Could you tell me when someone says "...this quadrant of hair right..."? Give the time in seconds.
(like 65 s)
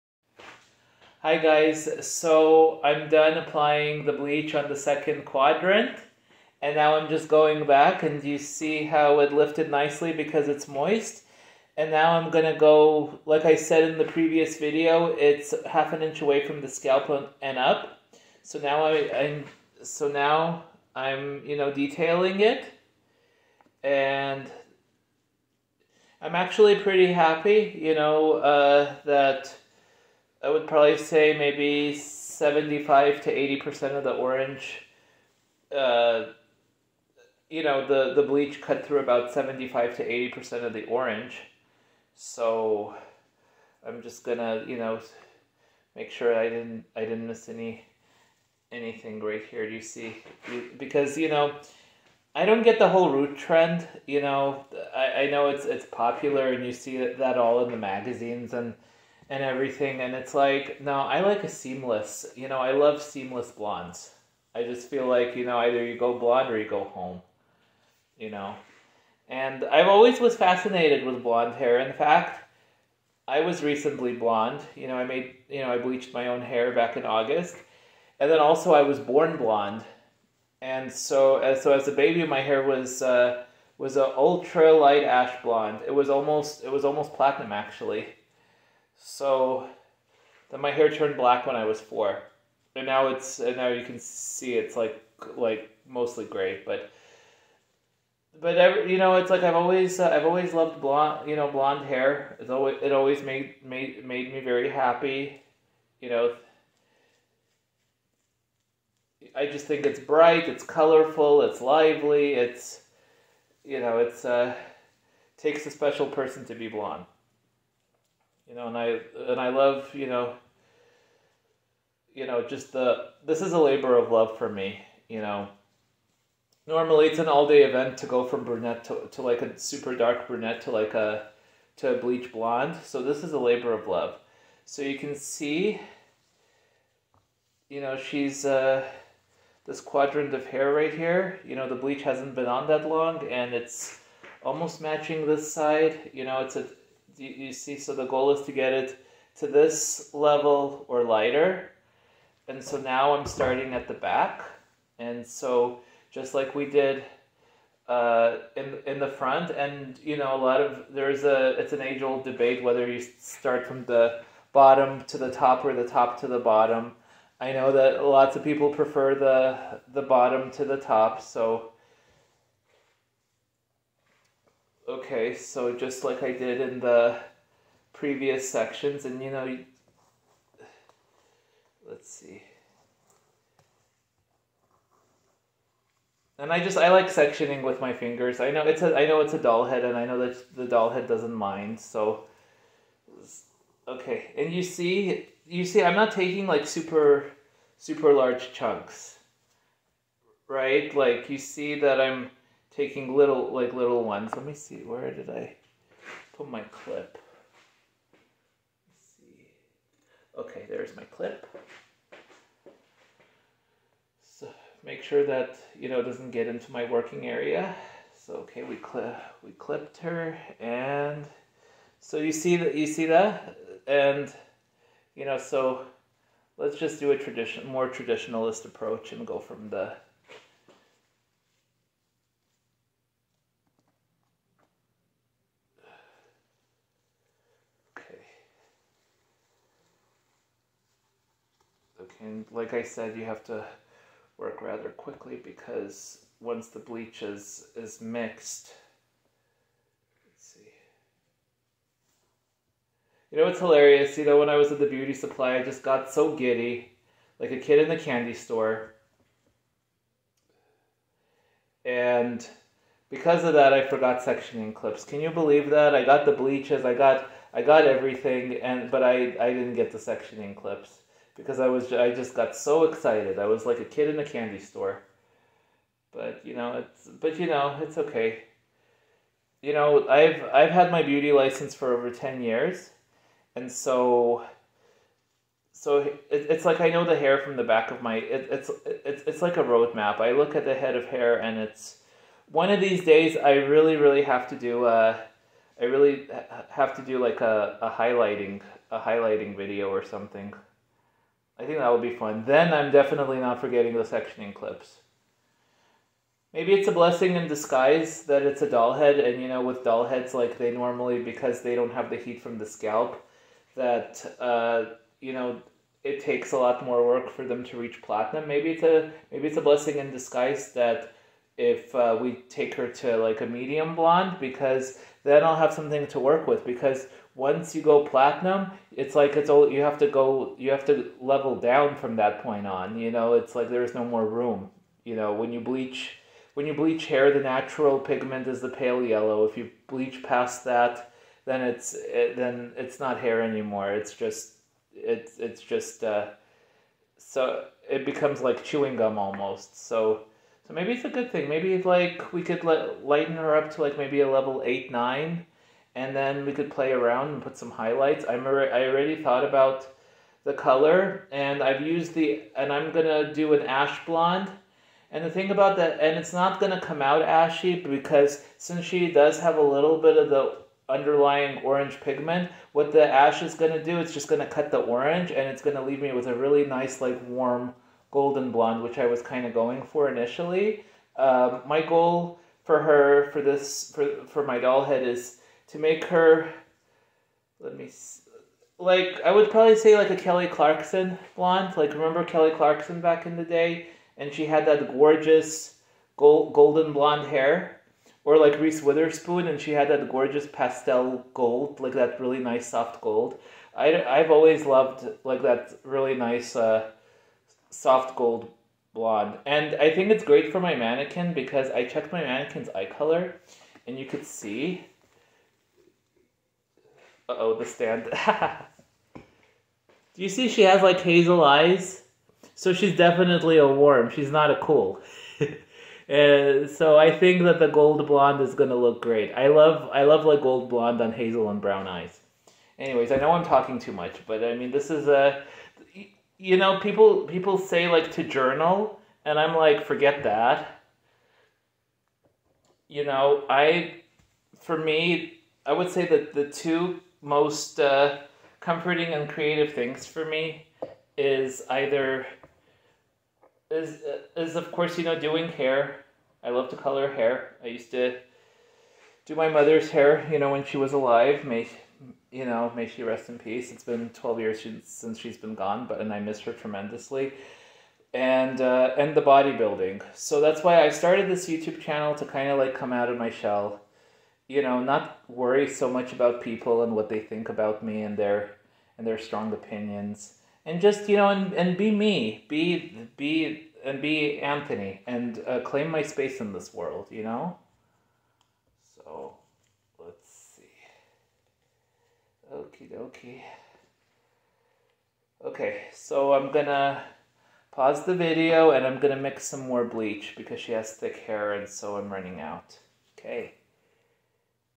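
139 s.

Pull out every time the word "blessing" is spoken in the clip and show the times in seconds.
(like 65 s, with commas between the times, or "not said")
306 s, 319 s.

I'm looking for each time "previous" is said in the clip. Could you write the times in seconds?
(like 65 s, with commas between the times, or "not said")
14 s, 177 s.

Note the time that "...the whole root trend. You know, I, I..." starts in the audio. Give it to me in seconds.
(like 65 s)
52 s.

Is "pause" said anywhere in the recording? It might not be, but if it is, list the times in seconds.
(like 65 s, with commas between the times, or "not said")
497 s.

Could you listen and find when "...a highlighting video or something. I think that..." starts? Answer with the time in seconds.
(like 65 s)
298 s.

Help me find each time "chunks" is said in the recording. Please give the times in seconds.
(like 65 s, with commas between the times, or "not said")
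198 s.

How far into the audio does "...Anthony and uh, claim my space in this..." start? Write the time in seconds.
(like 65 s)
484 s.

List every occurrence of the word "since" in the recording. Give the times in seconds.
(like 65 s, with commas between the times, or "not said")
368 s, 464 s.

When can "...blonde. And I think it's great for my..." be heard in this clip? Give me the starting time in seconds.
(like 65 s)
408 s.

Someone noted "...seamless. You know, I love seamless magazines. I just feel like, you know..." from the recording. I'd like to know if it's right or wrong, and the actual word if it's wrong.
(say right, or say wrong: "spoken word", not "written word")
wrong: "blondes", not "magazines".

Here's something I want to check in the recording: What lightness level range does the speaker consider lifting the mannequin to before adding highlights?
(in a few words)
level 8 or 9.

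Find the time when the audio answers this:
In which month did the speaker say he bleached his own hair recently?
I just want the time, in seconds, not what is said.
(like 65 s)
77 s.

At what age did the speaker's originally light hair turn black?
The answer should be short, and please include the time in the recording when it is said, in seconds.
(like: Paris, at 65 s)
4, at 91 s.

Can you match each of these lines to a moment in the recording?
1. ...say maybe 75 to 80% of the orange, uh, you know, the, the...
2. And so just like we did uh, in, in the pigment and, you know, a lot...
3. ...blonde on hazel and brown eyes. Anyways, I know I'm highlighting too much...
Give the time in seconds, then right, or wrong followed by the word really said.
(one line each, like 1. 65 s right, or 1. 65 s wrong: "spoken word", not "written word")
1. 30 s right
2. 154 s wrong: "front", not "pigment"
3. 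430 s wrong: "talking", not "highlighting".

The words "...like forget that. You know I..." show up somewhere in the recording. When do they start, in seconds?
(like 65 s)
439 s.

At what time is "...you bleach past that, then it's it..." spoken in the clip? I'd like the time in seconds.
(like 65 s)
339 s.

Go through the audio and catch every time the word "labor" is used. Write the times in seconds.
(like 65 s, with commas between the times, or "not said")
123 s, 133 s.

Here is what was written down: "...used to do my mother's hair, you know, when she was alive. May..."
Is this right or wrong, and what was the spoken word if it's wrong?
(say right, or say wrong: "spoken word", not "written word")
right.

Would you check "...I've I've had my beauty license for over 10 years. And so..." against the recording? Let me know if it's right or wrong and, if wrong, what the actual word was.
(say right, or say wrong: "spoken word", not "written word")
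right.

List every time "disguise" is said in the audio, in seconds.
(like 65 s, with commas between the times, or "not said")
307 s, 320 s.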